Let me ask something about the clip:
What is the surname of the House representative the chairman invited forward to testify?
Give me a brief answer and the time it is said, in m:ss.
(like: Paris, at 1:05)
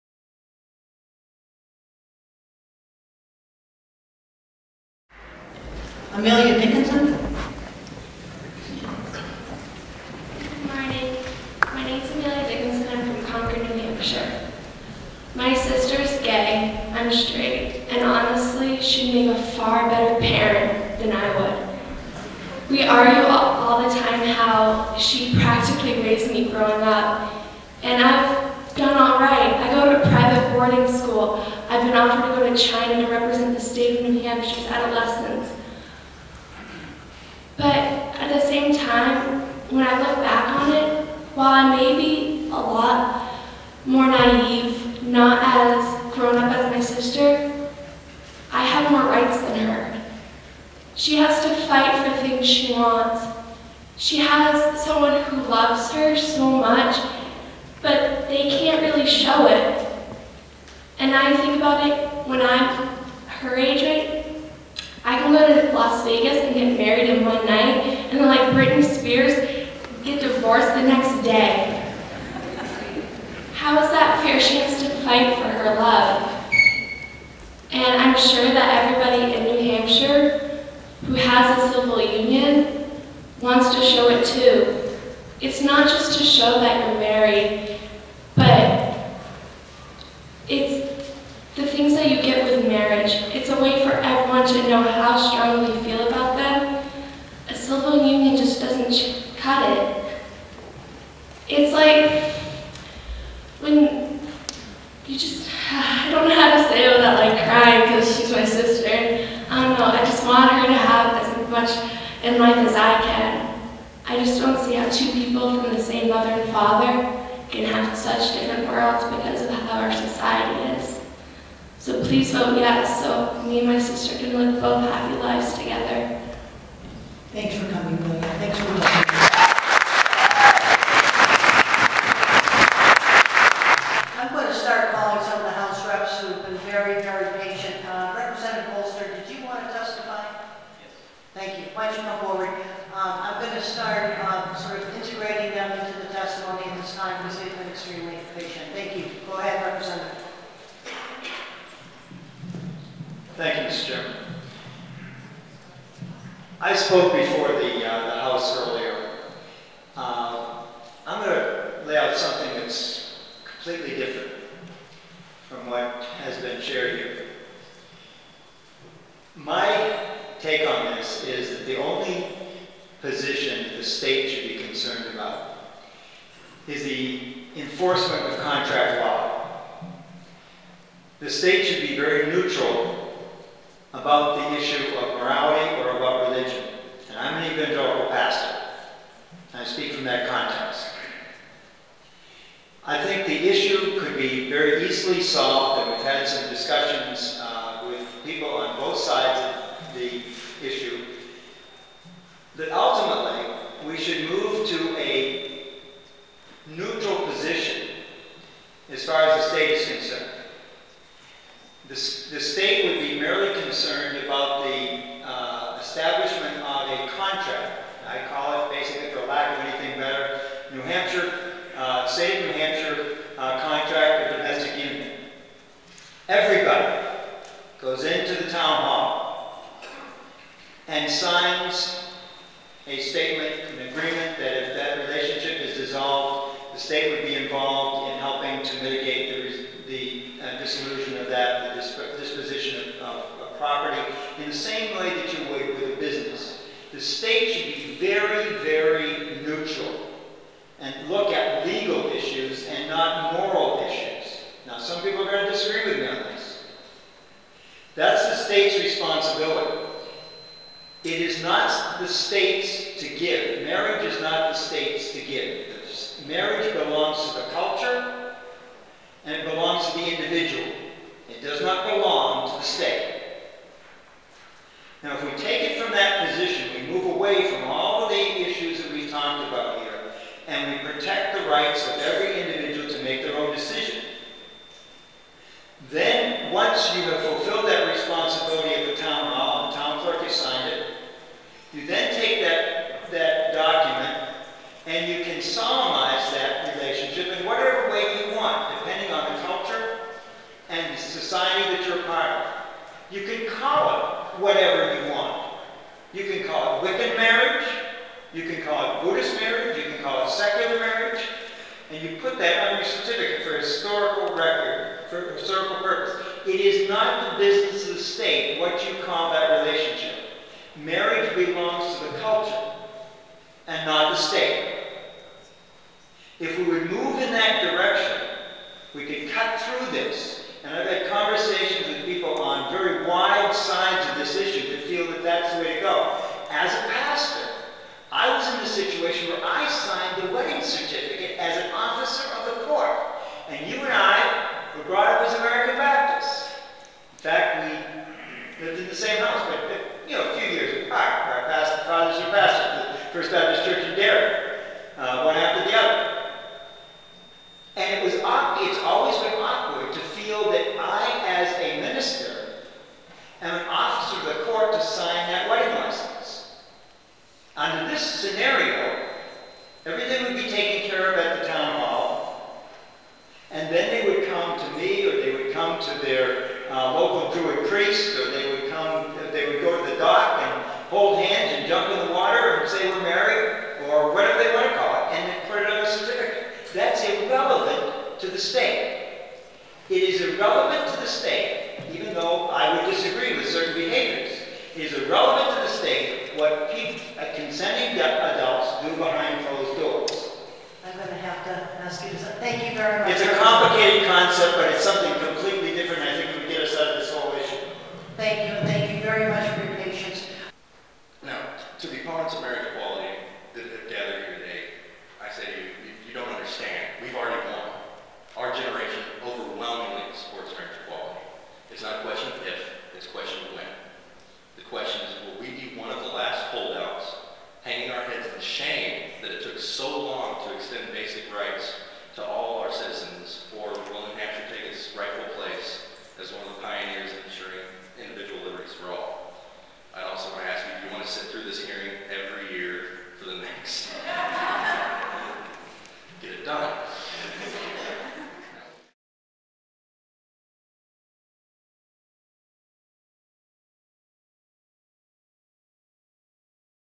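Bolster, at 2:18.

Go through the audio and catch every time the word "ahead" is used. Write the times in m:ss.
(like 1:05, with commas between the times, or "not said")
2:29.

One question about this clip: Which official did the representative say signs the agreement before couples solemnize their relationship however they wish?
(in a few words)
Town clerk.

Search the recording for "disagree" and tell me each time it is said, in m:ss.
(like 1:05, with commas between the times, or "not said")
4:15, 6:32.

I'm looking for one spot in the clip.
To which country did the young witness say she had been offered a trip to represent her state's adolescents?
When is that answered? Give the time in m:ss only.
0:32.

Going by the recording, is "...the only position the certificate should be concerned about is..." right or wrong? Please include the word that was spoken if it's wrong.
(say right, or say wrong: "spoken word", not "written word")
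wrong: "state", not "certificate".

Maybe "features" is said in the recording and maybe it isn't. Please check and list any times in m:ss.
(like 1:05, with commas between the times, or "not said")
not said.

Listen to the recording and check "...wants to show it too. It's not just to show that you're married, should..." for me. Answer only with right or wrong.
right.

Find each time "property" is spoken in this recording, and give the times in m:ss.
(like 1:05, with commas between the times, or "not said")
4:03.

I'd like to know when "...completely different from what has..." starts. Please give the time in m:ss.
2:43.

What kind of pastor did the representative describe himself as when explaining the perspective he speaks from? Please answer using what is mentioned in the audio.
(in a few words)
Evangelical.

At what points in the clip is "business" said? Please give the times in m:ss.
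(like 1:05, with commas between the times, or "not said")
4:05, 5:17.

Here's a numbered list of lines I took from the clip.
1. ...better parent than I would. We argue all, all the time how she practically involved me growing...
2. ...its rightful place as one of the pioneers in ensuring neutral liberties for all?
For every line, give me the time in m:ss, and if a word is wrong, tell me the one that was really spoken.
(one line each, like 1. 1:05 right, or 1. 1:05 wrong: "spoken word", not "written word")
1. 0:19 wrong: "raised", not "involved"
2. 7:14 wrong: "individual", not "neutral".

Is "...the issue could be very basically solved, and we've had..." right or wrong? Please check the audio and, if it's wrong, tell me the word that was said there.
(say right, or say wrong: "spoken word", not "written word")
wrong: "easily", not "basically".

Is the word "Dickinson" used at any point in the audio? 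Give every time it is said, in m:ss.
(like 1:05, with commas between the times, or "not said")
0:06, 0:12.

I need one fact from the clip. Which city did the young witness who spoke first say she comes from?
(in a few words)
Concord, New Hampshire.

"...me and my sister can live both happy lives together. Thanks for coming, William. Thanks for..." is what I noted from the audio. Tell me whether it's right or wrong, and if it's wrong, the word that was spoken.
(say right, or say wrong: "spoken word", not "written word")
right.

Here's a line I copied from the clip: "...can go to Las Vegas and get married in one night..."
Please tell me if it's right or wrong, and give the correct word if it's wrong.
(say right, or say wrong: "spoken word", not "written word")
right.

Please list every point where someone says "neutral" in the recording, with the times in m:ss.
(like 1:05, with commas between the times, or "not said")
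3:02, 3:26, 4:09.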